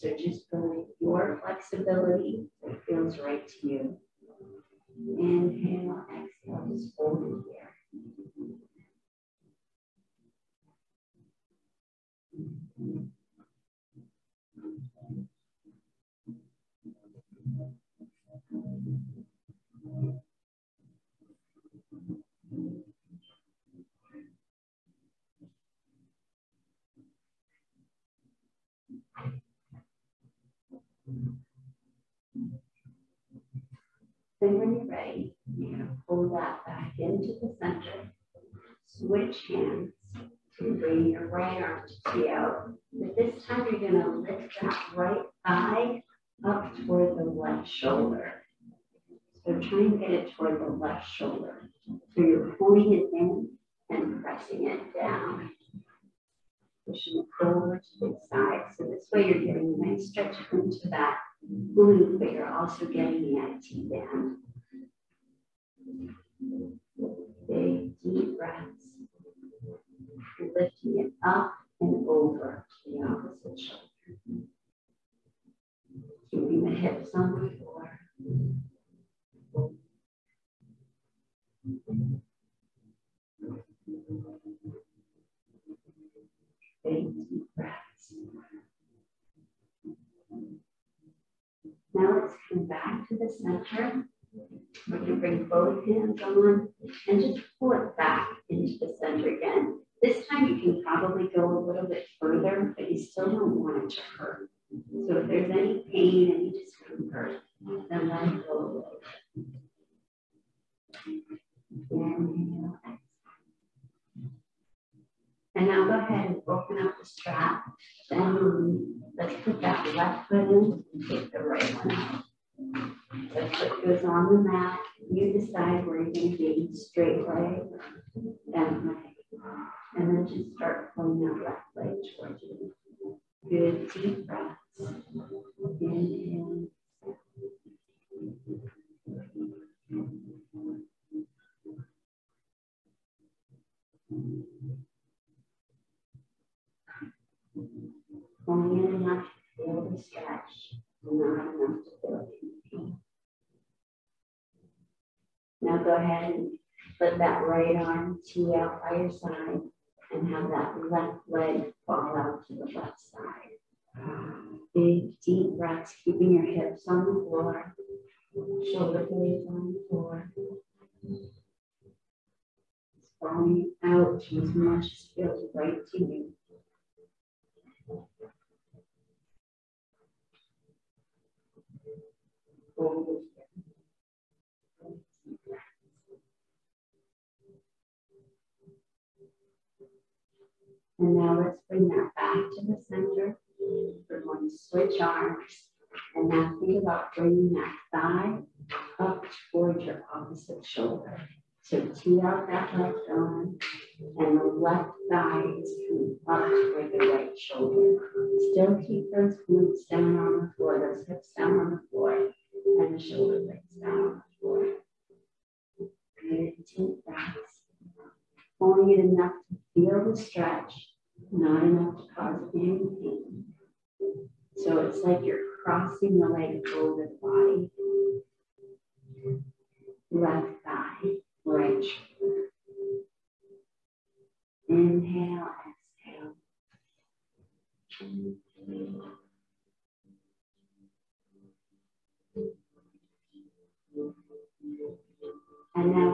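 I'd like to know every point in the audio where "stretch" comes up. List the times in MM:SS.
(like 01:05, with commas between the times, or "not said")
01:00, 02:29, 03:40.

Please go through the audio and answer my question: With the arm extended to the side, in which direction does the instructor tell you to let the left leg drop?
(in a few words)
left side.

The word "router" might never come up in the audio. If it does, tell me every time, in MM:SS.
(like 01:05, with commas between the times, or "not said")
not said.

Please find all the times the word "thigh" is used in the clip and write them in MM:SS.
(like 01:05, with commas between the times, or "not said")
00:45, 03:17, 03:25, 03:50.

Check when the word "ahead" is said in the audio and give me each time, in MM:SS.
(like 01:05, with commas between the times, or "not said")
01:55, 02:35.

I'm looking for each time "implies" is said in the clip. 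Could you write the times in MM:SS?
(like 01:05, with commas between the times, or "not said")
not said.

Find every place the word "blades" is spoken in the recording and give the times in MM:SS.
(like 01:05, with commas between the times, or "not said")
02:49, 03:33.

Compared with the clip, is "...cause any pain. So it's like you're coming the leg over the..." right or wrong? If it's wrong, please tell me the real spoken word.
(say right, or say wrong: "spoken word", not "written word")
wrong: "crossing", not "coming".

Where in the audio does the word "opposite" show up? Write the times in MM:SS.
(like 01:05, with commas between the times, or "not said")
01:13, 03:20.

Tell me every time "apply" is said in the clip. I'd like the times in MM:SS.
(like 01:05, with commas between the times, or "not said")
not said.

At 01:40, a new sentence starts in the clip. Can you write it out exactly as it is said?
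This time you can probably go a little bit further, but you still don't want it to hurt.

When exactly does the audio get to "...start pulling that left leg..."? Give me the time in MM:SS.
02:10.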